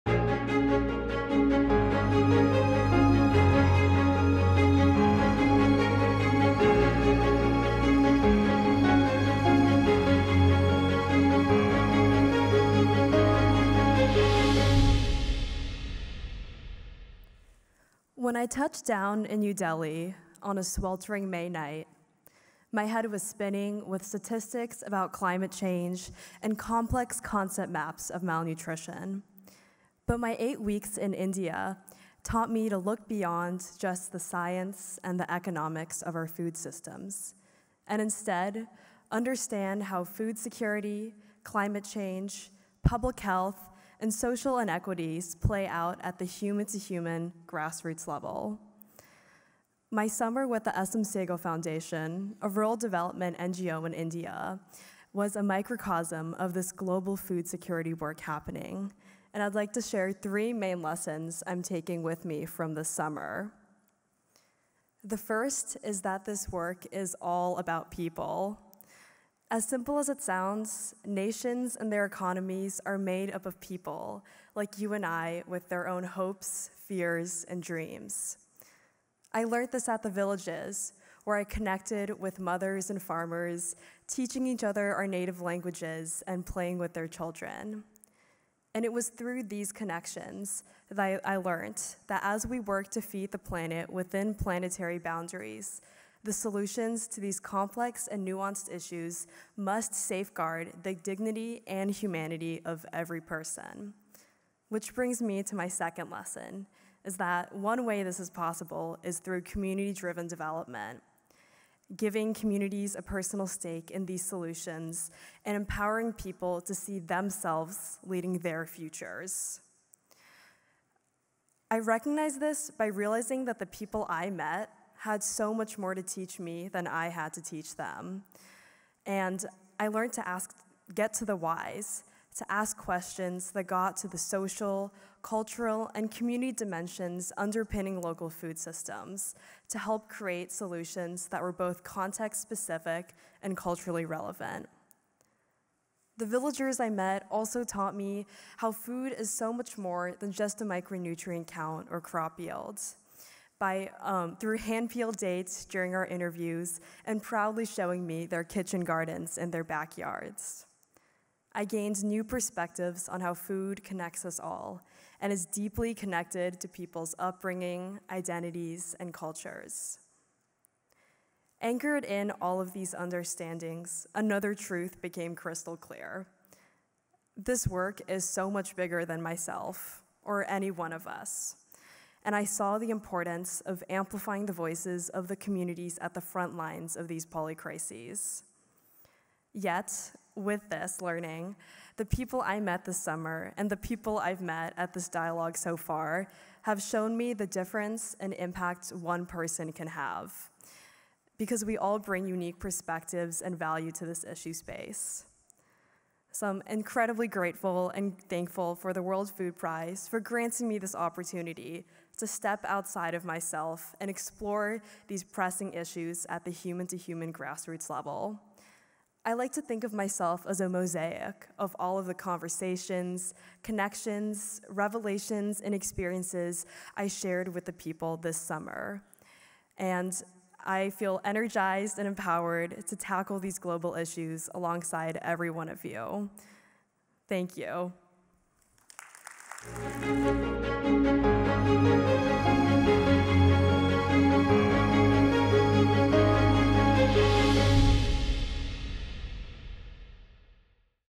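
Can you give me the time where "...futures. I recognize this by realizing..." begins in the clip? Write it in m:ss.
1:58.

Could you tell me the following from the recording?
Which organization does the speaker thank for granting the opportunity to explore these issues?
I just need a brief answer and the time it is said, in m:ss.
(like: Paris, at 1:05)
World Food Prize, at 3:29.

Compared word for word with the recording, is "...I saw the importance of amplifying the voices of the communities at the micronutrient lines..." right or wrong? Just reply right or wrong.
wrong.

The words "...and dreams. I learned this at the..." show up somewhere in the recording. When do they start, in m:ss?
1:17.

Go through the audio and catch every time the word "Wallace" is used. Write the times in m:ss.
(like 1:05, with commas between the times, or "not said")
not said.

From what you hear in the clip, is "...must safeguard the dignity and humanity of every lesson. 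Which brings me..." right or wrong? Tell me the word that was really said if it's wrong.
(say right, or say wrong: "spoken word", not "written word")
wrong: "person", not "lesson".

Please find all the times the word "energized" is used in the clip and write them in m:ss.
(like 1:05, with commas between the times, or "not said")
3:51.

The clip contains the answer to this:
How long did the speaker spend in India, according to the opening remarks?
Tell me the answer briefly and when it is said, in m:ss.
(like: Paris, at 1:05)
8 weeks, at 0:30.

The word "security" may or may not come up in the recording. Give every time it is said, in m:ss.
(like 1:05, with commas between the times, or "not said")
0:40, 0:57.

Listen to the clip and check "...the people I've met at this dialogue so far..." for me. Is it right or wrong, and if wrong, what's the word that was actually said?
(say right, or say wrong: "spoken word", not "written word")
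right.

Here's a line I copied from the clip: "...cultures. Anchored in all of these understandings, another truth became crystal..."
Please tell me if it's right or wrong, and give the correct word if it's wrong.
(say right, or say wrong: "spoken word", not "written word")
right.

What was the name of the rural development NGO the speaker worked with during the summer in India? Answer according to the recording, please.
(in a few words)
SM Sehgal Foundation.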